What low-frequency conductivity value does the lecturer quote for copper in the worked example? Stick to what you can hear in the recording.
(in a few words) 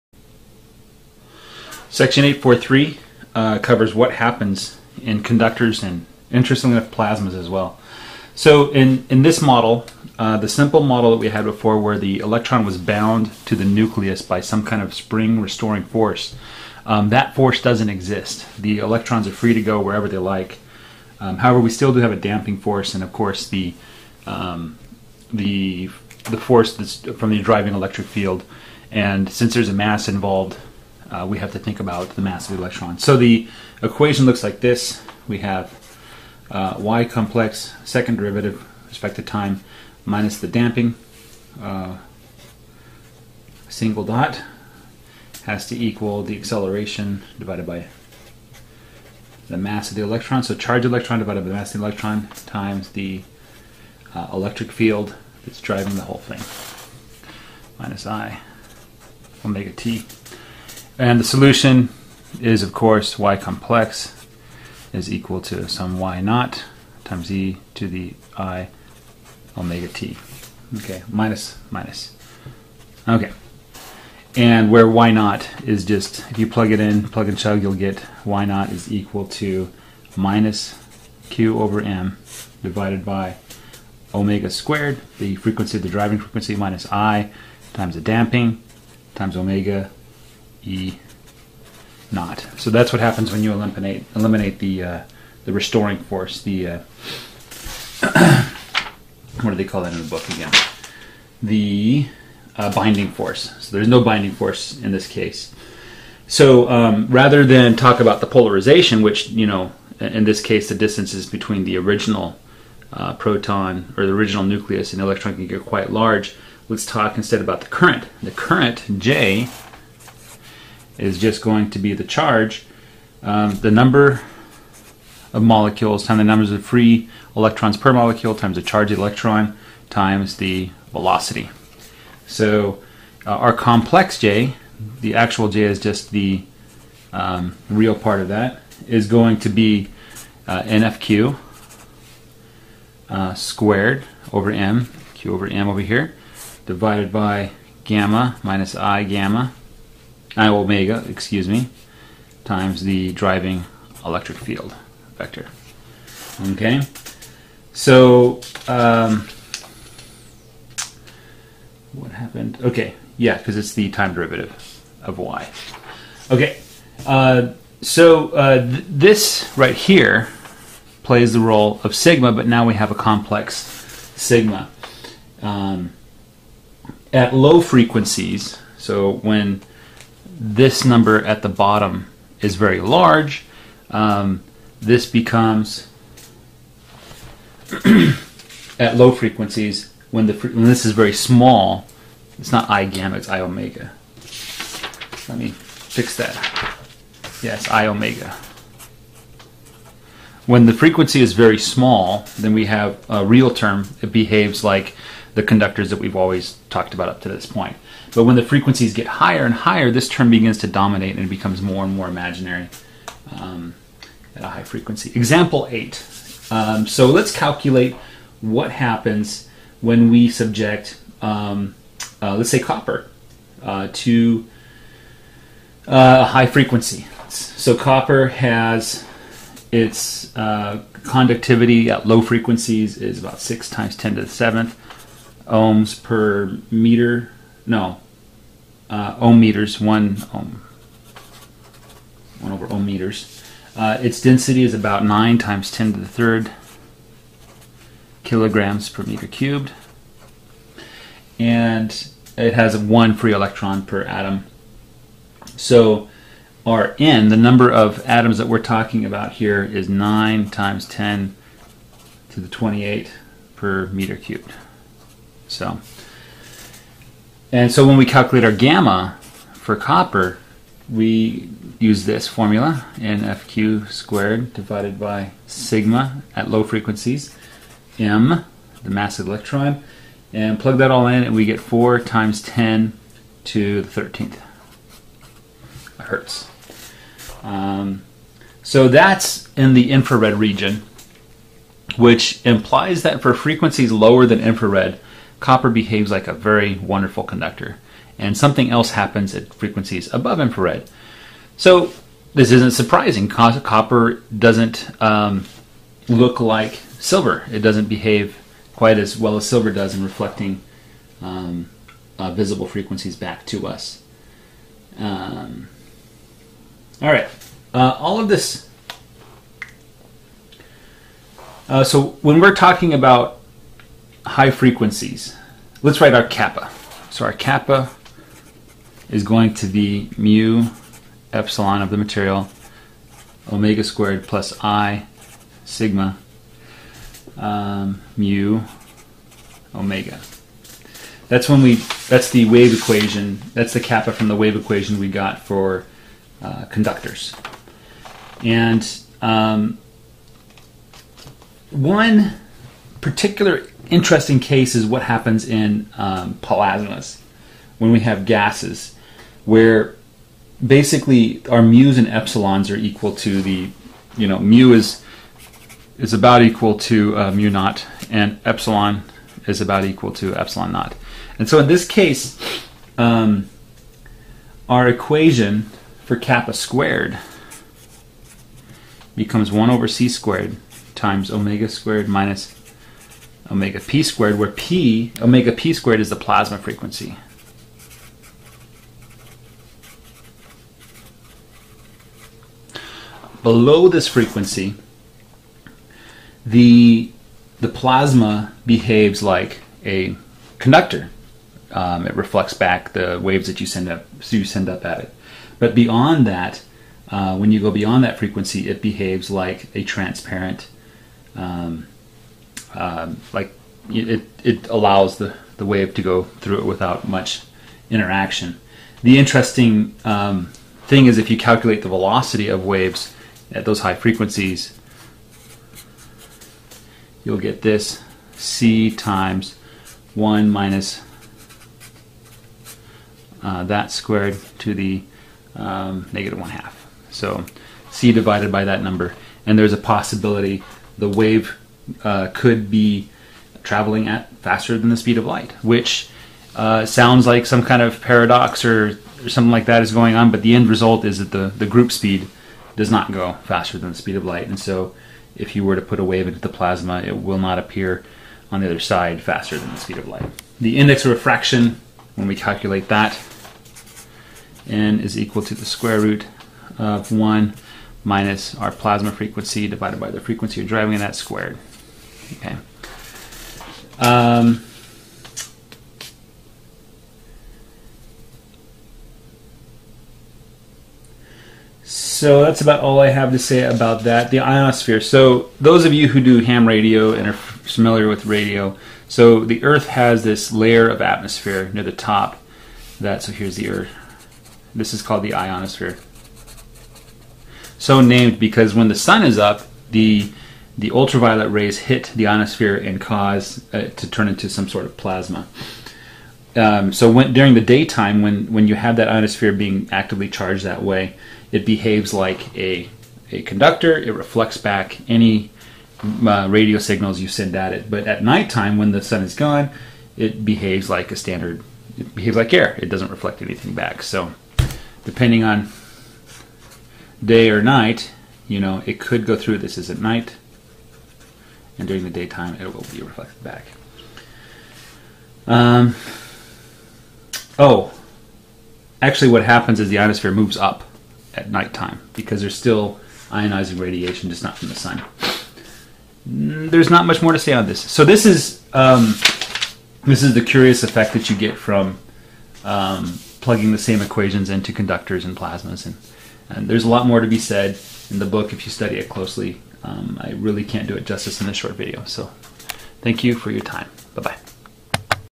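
6 times 10^7 per ohm meter.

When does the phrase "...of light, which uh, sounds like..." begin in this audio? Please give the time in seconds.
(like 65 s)
445 s.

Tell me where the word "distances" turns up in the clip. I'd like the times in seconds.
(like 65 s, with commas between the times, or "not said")
110 s.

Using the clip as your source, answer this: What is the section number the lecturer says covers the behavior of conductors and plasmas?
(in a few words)
843.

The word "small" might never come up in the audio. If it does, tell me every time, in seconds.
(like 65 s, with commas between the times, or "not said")
191 s, 201 s.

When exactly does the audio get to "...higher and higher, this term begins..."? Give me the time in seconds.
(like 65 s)
209 s.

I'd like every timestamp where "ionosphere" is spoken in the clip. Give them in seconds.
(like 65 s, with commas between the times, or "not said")
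484 s, 495 s, 502 s, 509 s, 539 s.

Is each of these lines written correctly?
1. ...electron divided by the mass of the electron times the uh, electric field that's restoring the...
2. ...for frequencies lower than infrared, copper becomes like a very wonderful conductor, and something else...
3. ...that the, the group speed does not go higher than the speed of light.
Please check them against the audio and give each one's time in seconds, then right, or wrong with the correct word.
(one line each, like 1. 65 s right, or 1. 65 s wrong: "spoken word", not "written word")
1. 50 s wrong: "driving", not "restoring"
2. 293 s wrong: "behaves", not "becomes"
3. 451 s wrong: "faster", not "higher".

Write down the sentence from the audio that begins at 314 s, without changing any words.
Um, all right, uh, all of this.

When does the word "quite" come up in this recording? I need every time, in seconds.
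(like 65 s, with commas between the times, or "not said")
115 s, 308 s.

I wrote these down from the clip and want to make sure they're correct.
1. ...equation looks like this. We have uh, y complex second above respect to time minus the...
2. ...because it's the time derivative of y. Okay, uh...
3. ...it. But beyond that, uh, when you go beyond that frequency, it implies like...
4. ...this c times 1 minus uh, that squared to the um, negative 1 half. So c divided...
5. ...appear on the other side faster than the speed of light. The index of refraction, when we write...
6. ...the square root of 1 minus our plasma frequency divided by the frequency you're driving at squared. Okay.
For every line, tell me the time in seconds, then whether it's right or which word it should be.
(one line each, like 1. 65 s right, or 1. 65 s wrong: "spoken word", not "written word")
1. 33 s wrong: "derivative", not "above"
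2. 163 s right
3. 404 s wrong: "behaves", not "implies"
4. 427 s right
5. 457 s wrong: "calculate", not "write"
6. 465 s right.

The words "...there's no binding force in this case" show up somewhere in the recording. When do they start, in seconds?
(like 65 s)
103 s.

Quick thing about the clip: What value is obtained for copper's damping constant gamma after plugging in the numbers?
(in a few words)
4 times 10^13 hertz.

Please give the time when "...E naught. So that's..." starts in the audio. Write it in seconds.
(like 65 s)
90 s.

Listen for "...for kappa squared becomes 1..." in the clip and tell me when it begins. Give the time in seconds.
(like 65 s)
376 s.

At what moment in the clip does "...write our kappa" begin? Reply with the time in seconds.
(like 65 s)
326 s.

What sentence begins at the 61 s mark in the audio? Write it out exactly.
And the solution is, of course, y complex is equal to some y naught times e to the i omega t.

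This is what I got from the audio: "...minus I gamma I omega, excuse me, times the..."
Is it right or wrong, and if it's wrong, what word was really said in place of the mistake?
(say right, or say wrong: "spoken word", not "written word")
right.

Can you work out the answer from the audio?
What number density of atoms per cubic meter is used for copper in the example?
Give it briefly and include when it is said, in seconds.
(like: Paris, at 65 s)
9 times 10^28, at 259 s.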